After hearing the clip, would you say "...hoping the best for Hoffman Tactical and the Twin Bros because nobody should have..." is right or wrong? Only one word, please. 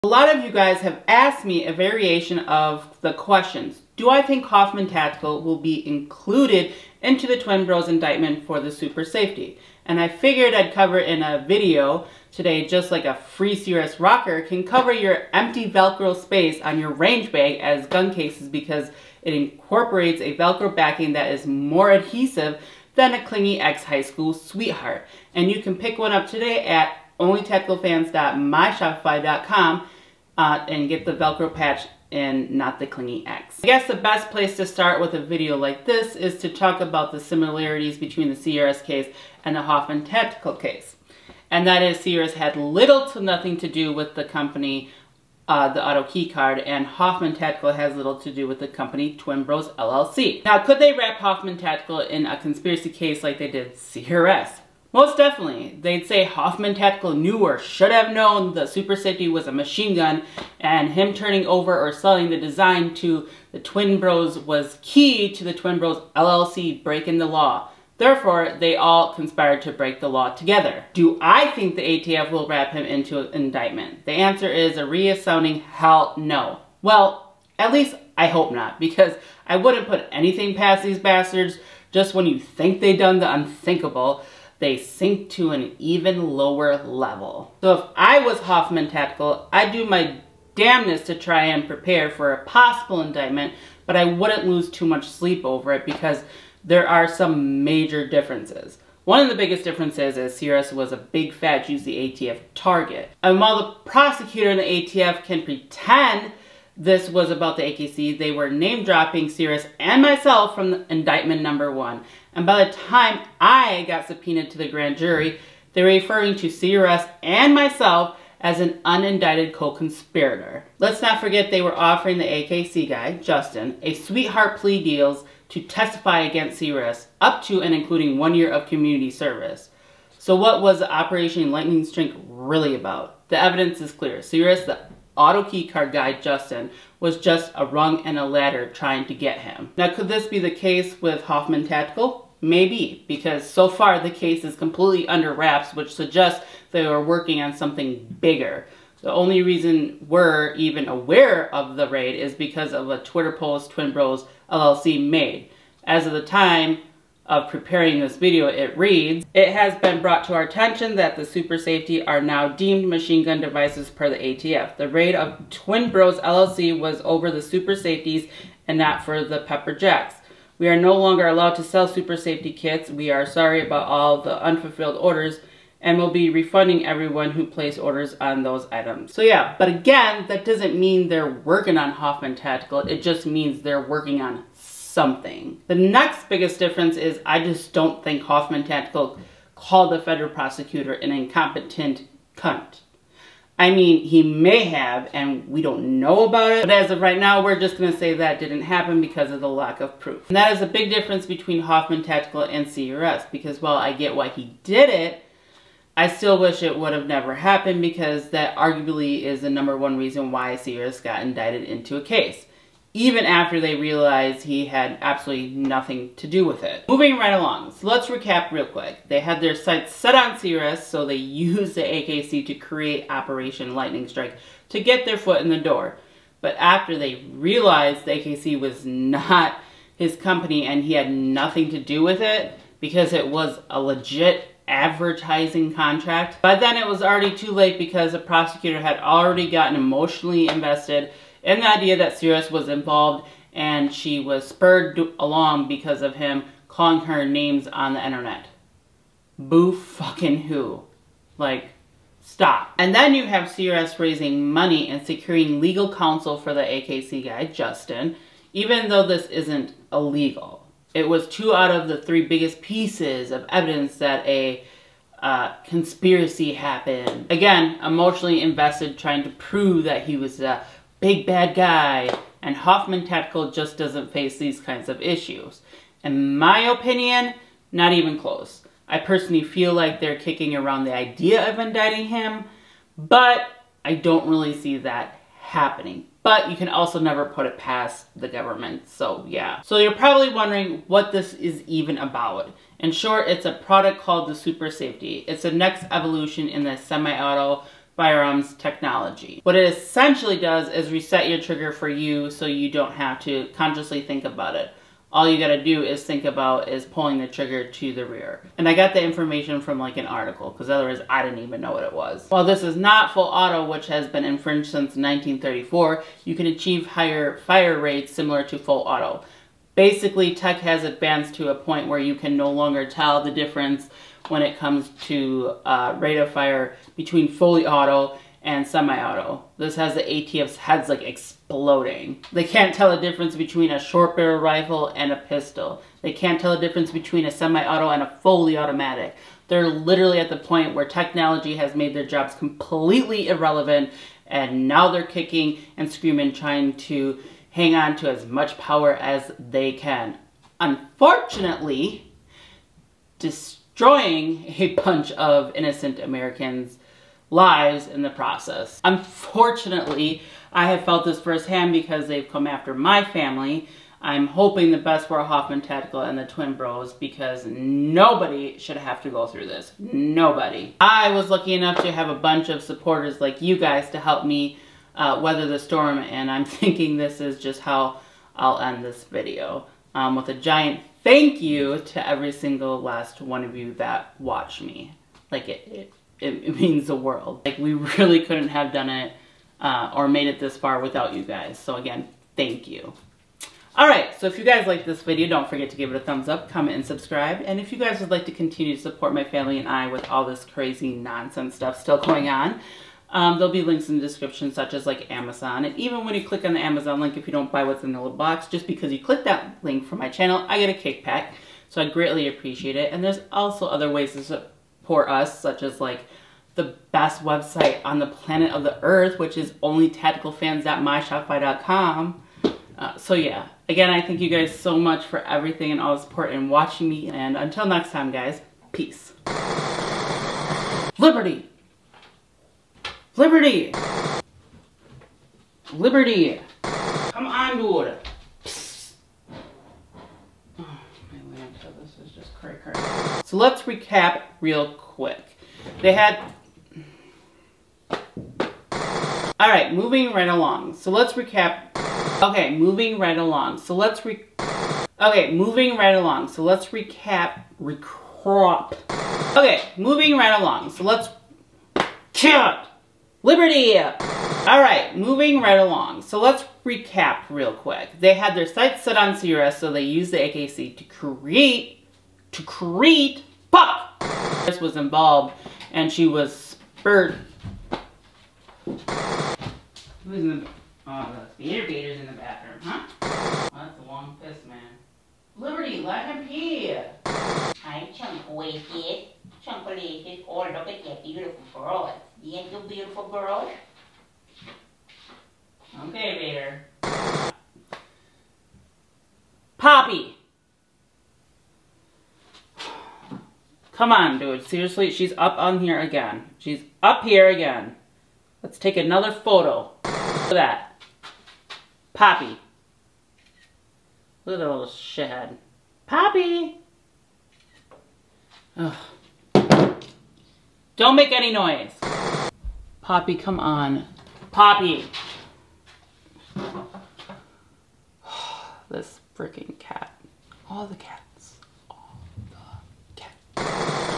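right.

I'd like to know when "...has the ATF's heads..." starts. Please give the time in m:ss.
5:29.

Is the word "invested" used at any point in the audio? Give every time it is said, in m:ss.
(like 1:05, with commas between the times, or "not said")
4:00, 4:28.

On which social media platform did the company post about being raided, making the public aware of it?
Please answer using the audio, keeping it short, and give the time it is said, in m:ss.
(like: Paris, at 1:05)
Twitter, at 2:32.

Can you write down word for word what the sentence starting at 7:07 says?
And until next time, guys, peace.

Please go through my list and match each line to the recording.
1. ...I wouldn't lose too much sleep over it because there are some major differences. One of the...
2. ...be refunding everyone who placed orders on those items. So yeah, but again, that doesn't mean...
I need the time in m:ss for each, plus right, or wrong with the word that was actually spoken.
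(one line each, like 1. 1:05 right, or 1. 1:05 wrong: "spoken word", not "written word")
1. 1:33 right
2. 2:56 right.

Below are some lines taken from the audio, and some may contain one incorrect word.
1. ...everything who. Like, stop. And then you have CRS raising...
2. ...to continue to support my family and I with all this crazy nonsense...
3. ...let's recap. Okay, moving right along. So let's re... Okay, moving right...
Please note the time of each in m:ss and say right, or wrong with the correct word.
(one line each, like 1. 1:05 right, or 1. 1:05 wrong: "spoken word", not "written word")
1. 4:09 wrong: "fucking", not "everything"
2. 6:38 right
3. 7:30 right.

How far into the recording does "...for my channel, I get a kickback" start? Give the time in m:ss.
6:49.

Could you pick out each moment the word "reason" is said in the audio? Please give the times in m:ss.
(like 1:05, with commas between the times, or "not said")
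2:29, 3:29.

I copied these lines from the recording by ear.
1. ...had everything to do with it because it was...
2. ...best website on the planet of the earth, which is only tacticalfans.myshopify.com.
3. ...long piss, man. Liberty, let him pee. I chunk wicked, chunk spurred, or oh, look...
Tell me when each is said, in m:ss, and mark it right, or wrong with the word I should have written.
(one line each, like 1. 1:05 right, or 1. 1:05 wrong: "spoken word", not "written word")
1. 3:50 wrong: "nothing", not "everything"
2. 6:56 right
3. 8:03 wrong: "related", not "spurred".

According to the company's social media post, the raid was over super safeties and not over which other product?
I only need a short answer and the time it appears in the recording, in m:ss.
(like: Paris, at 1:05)
Pepper Jacks, at 2:49.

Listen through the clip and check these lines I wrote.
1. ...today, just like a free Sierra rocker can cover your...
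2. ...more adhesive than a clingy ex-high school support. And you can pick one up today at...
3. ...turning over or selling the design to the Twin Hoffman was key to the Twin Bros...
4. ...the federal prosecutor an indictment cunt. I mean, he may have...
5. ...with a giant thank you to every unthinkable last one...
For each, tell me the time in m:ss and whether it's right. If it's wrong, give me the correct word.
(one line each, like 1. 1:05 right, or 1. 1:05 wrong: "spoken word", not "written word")
1. 0:12 wrong: "CRS", not "Sierra"
2. 0:21 wrong: "sweetheart", not "support"
3. 1:01 wrong: "Bros", not "Hoffman"
4. 3:09 wrong: "incompetent", not "indictment"
5. 6:20 wrong: "single", not "unthinkable".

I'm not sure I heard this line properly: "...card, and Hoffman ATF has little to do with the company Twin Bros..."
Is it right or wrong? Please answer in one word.
wrong.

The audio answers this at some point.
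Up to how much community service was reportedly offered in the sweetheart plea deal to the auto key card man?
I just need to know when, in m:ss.
2:08.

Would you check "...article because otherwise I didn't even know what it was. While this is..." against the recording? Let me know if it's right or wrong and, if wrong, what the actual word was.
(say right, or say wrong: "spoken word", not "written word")
right.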